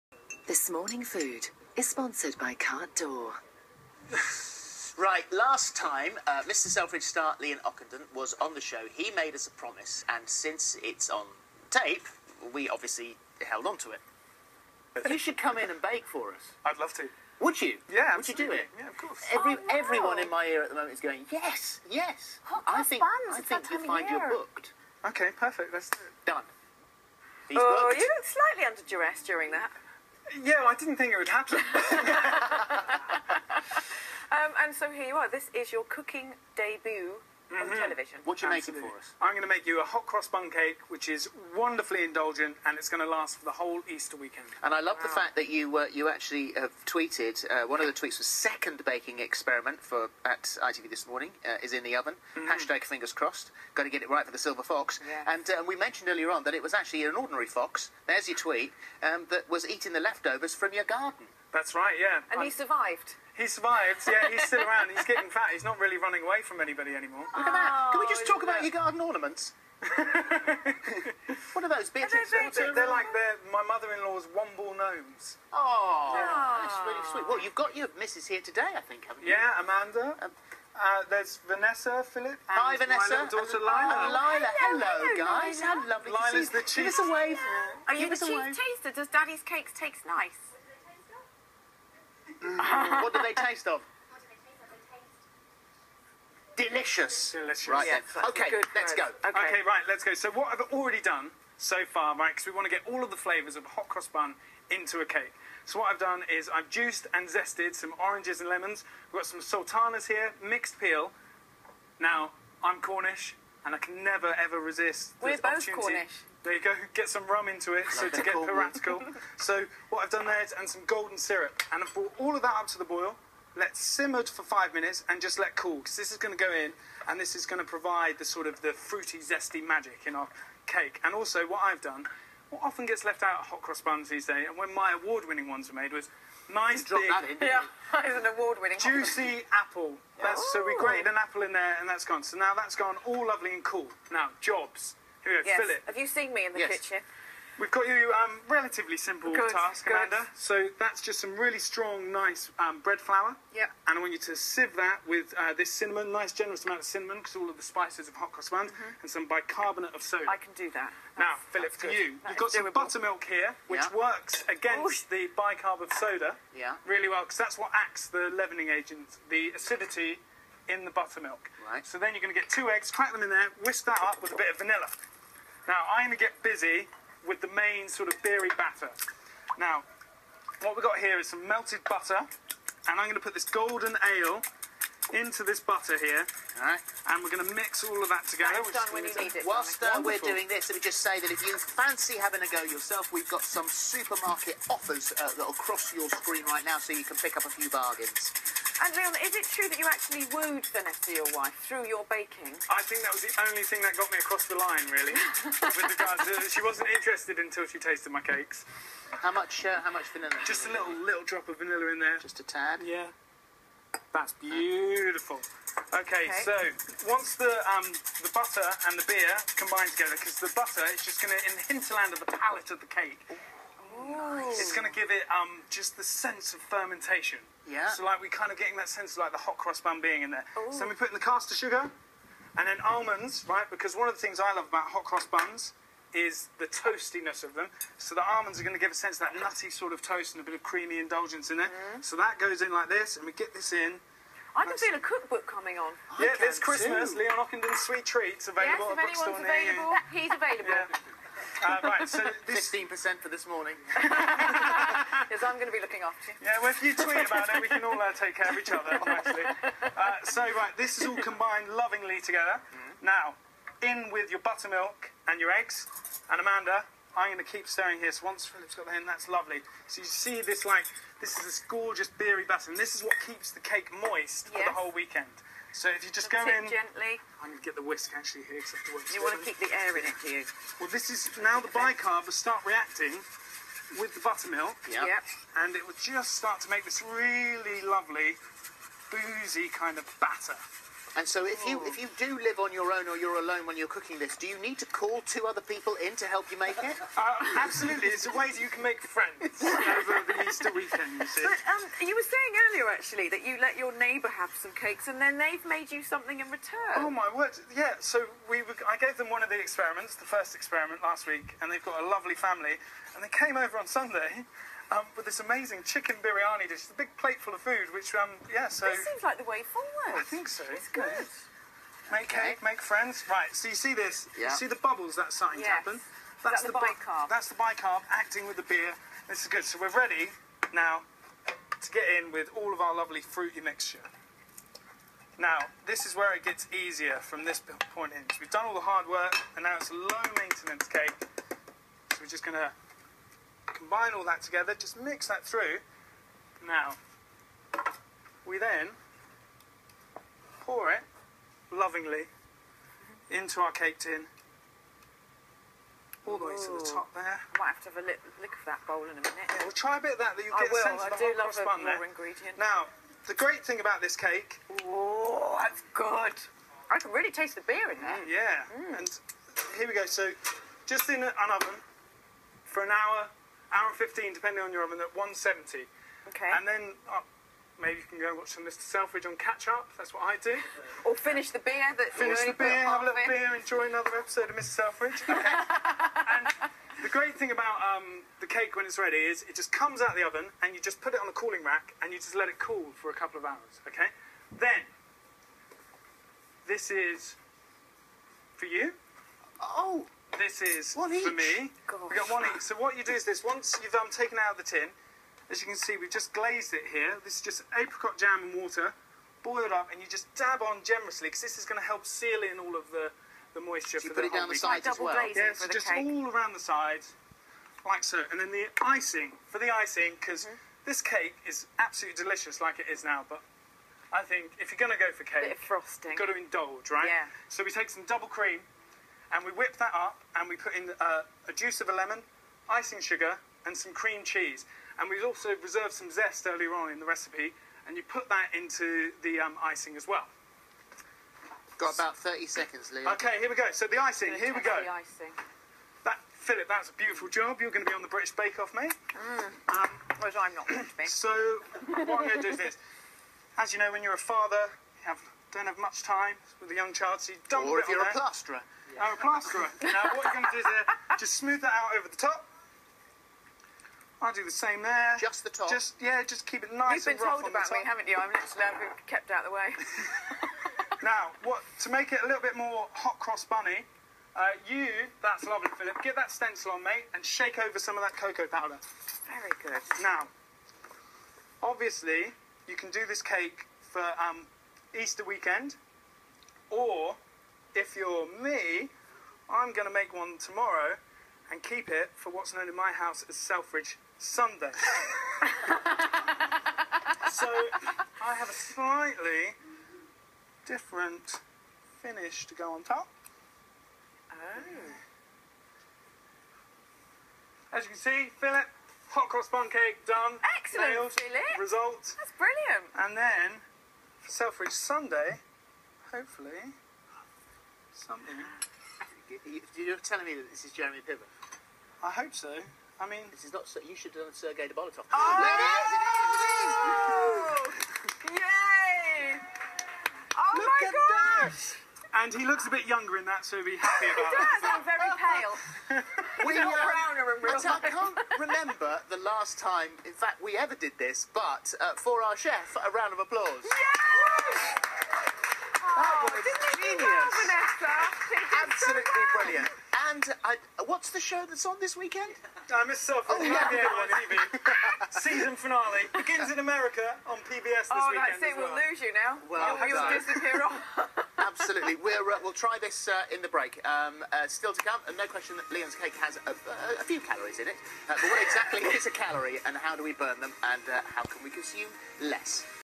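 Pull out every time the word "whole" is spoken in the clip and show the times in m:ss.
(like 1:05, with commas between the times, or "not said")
0:43, 4:34, 6:01.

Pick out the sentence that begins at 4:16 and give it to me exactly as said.
Yeah, well, if you tweet about it, we can all uh, take care of each other, nicely.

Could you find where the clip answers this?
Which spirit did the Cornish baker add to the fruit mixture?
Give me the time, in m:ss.
1:57.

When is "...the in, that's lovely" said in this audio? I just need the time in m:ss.
4:28.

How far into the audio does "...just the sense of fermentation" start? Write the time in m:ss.
3:45.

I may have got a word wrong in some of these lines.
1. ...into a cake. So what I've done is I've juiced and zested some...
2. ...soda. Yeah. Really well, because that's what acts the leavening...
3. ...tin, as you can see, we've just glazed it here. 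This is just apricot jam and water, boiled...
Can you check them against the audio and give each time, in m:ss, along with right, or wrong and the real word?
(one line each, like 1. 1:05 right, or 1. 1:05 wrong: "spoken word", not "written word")
1. 1:44 right
2. 2:45 right
3. 6:44 right.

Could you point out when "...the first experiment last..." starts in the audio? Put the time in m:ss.
5:10.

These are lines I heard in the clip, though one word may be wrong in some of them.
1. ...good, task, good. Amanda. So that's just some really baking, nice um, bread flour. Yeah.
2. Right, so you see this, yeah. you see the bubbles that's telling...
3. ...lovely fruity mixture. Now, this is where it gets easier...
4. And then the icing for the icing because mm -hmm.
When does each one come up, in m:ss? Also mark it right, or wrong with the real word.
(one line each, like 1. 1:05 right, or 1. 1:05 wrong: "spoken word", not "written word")
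1. 2:29 wrong: "strong", not "baking"
2. 5:23 wrong: "starting", not "telling"
3. 5:32 right
4. 6:58 right.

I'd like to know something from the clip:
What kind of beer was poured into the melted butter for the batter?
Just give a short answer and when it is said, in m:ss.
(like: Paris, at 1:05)
Golden ale, at 3:03.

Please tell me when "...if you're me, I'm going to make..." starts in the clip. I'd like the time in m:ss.
8:07.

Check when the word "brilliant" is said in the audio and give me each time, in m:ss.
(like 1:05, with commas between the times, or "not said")
8:32, 9:09.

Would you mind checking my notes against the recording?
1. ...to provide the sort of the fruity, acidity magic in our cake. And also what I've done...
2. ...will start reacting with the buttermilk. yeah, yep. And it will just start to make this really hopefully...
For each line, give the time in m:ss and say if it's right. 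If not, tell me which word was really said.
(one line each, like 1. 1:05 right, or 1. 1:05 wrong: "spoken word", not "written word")
1. 2:07 wrong: "zesty", not "acidity"
2. 4:42 wrong: "lovely", not "hopefully".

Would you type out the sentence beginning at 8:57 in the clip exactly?
I can't remember the last time, in fact, we ever did this.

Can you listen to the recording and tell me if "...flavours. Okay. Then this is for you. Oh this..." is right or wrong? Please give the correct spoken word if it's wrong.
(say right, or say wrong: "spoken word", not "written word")
wrong: "hours", not "flavours".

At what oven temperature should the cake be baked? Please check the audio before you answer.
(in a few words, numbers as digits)
170.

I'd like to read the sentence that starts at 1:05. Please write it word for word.
He's not really running away from anybody anymore.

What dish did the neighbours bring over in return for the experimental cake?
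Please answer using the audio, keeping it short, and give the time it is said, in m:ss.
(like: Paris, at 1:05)
Chicken biryani, at 5:15.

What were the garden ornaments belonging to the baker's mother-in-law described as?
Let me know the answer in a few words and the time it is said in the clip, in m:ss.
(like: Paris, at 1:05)
Womble gnomes, at 1:14.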